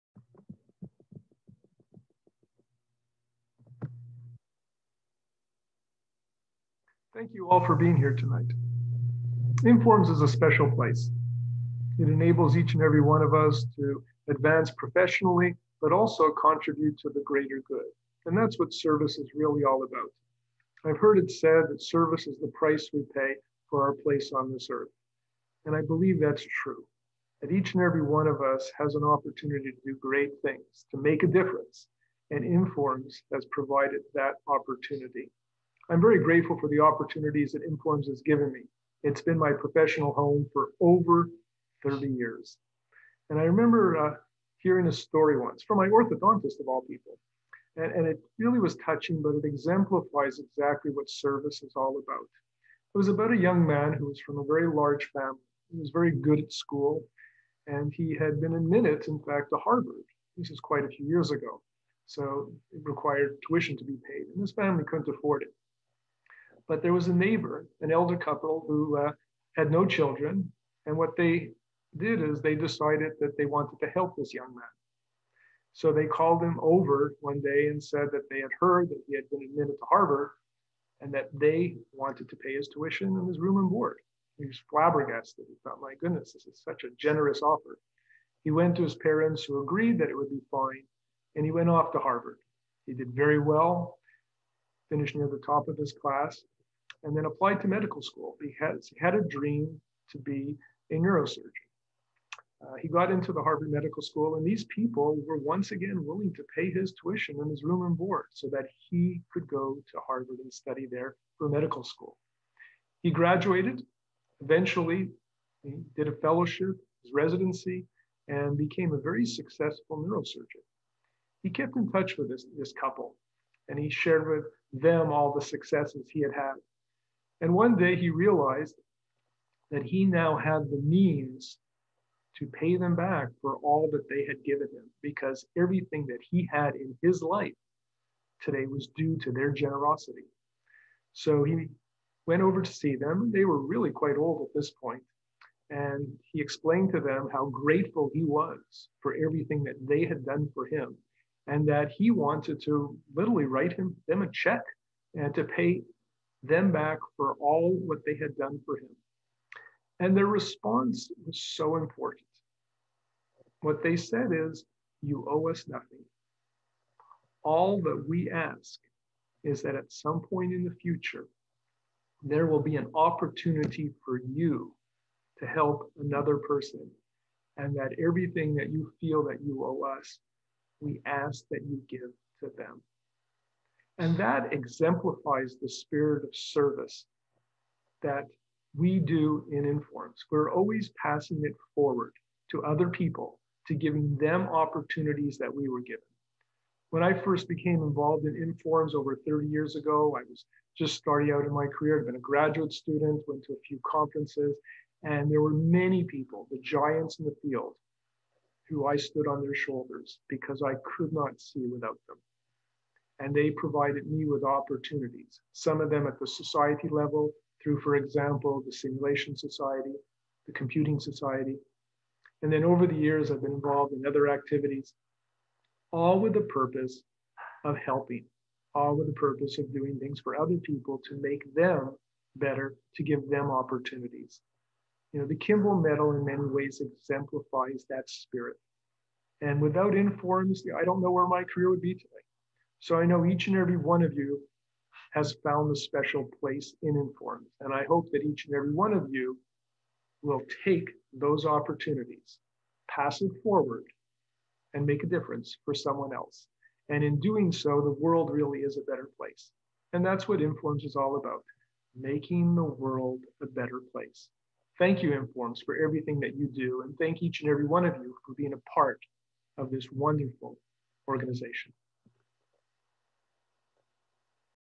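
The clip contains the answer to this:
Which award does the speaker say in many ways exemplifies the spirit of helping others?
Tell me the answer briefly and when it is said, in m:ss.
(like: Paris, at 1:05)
Kimball Medal, at 3:55.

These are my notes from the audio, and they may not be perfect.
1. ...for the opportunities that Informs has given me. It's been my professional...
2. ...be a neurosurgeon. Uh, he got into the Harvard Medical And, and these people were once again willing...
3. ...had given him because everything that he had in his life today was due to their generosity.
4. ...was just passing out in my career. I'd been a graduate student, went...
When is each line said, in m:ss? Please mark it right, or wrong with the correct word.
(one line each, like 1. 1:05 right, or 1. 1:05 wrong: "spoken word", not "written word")
1. 0:36 right
2. 1:40 wrong: "School", not "And"
3. 2:14 right
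4. 3:20 wrong: "starting", not "passing".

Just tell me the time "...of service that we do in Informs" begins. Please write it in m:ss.
3:06.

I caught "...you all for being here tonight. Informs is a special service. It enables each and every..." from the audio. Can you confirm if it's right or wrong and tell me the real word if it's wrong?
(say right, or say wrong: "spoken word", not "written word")
wrong: "place", not "service".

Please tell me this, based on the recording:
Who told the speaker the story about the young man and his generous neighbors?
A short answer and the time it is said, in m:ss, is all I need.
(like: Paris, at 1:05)
orthodontist, at 0:45.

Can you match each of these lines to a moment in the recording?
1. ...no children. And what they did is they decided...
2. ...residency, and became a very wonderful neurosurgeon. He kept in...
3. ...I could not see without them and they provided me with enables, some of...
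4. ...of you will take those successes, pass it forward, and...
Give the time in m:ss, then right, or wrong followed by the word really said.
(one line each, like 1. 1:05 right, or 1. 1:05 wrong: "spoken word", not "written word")
1. 1:09 right
2. 1:57 wrong: "successful", not "wonderful"
3. 3:30 wrong: "opportunities", not "enables"
4. 4:08 wrong: "opportunities", not "successes".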